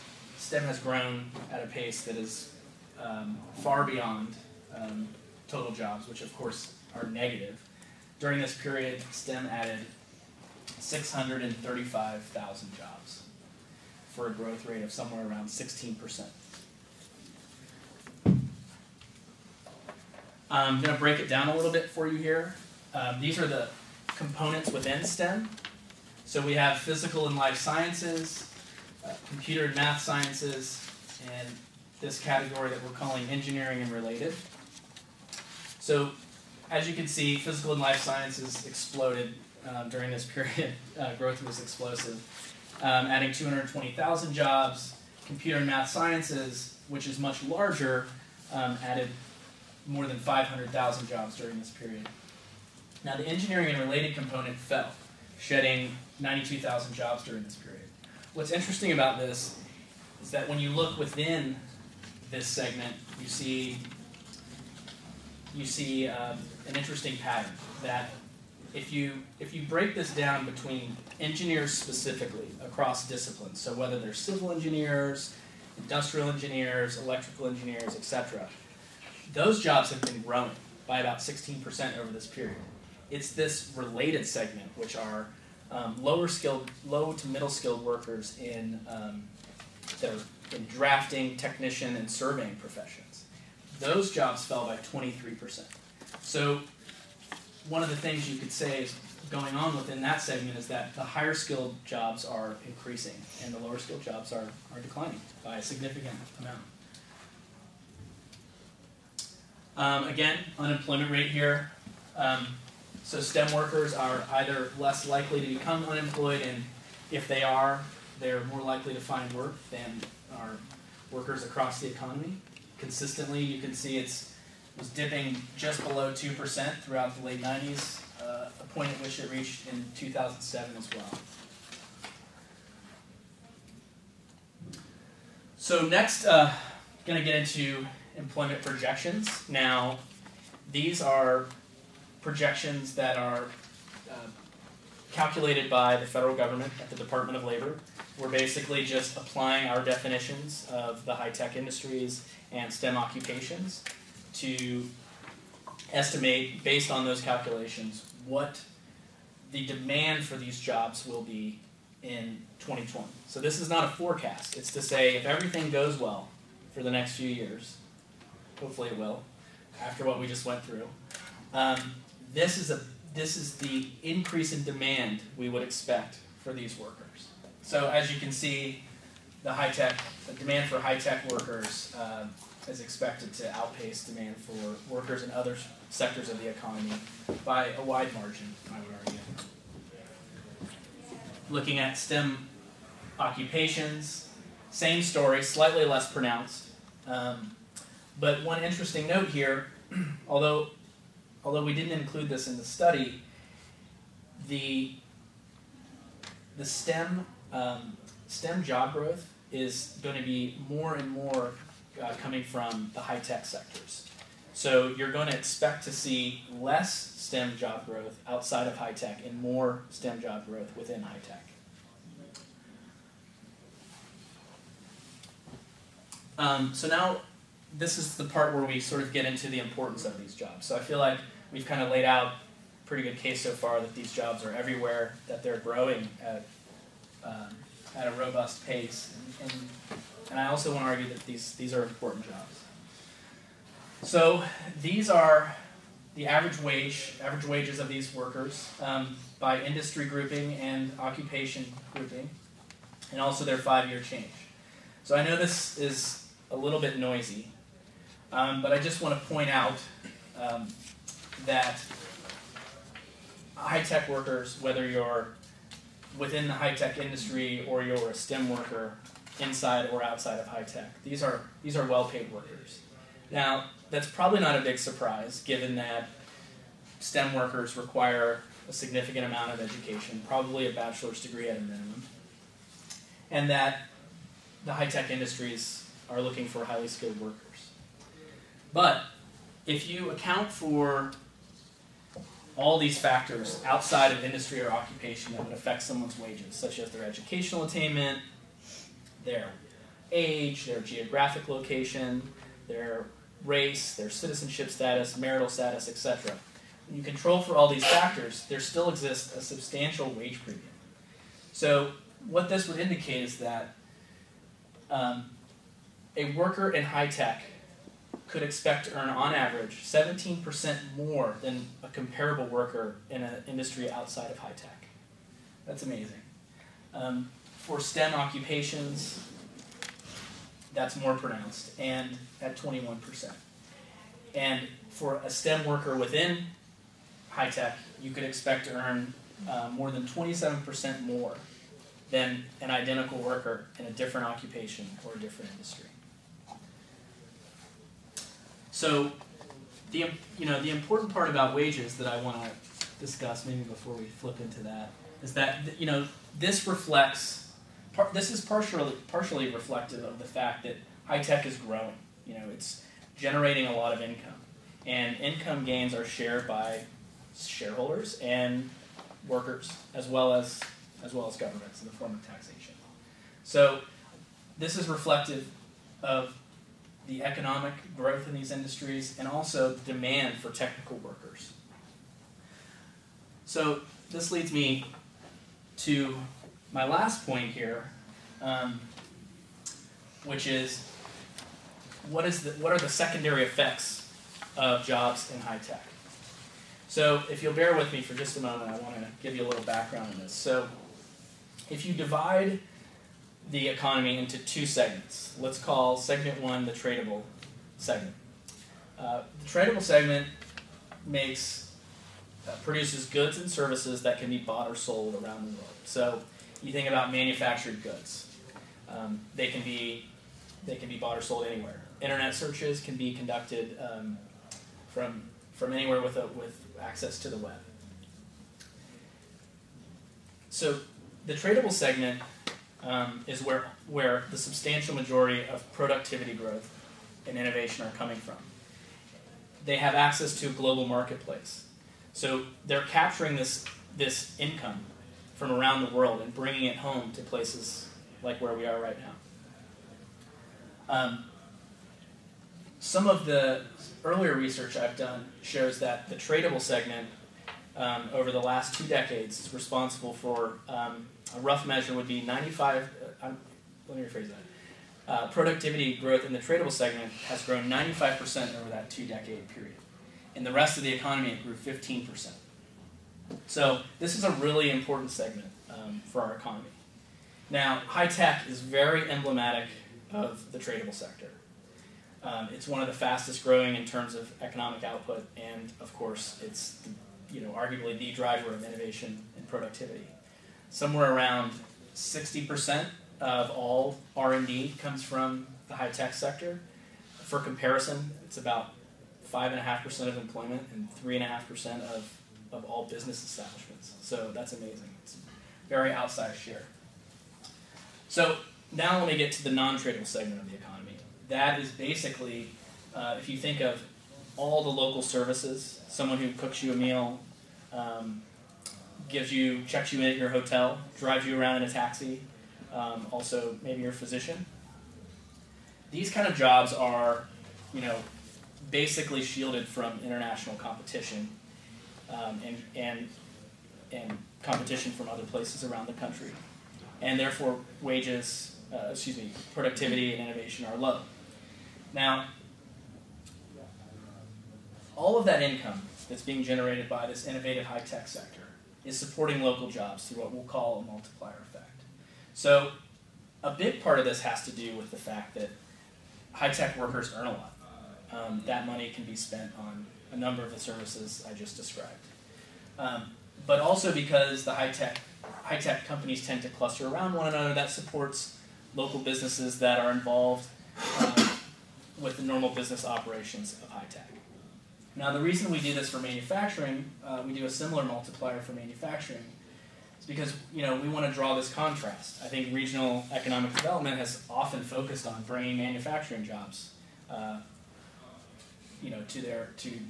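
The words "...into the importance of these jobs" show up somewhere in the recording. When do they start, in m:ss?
3:49.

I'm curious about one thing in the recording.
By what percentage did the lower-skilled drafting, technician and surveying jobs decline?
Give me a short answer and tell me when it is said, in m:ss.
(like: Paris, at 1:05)
23%, at 1:34.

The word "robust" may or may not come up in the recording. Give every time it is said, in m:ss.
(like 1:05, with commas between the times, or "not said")
3:58.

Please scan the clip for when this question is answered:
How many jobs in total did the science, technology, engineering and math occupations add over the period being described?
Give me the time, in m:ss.
0:10.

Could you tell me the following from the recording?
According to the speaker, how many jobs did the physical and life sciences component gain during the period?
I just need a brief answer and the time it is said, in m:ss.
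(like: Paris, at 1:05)
220,000, at 0:43.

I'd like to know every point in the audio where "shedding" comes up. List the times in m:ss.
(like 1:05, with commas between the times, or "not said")
0:55.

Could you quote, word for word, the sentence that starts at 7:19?
They have access to a global marketplace.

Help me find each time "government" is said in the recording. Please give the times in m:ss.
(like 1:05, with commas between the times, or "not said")
2:26, 6:11.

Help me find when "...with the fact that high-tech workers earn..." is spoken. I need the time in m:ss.
9:14.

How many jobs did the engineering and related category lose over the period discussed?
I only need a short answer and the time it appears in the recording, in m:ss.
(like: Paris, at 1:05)
92,000, at 0:56.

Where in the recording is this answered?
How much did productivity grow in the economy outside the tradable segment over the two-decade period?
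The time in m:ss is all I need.
7:51.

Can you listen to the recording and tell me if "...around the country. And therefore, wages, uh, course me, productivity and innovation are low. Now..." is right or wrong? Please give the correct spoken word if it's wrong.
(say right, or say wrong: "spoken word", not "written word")
wrong: "excuse", not "course".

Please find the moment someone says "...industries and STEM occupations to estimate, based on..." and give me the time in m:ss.
2:31.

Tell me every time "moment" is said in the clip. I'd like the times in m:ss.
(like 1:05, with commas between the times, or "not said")
6:38.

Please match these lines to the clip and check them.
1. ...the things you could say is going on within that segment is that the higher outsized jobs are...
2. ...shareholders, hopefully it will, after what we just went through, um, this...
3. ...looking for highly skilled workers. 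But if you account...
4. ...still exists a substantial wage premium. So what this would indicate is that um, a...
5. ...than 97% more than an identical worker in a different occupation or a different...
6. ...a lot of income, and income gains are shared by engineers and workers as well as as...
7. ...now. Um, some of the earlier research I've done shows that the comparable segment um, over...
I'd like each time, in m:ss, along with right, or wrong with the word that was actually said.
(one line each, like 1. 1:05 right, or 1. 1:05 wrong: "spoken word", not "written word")
1. 1:37 wrong: "skilled", not "outsized"
2. 2:47 wrong: "years", not "shareholders"
3. 4:46 right
4. 5:08 right
5. 5:39 wrong: "27", not "97"
6. 6:03 wrong: "shareholders", not "engineers"
7. 7:29 wrong: "tradable", not "comparable".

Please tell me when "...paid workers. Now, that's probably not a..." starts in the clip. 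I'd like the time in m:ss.
4:32.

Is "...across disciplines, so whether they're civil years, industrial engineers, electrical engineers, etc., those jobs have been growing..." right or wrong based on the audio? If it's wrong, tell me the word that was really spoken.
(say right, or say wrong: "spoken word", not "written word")
wrong: "engineers", not "years".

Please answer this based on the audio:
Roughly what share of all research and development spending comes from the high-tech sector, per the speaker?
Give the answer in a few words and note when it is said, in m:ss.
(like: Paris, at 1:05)
60%, at 8:11.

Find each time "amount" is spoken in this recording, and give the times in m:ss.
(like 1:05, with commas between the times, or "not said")
1:46, 4:39.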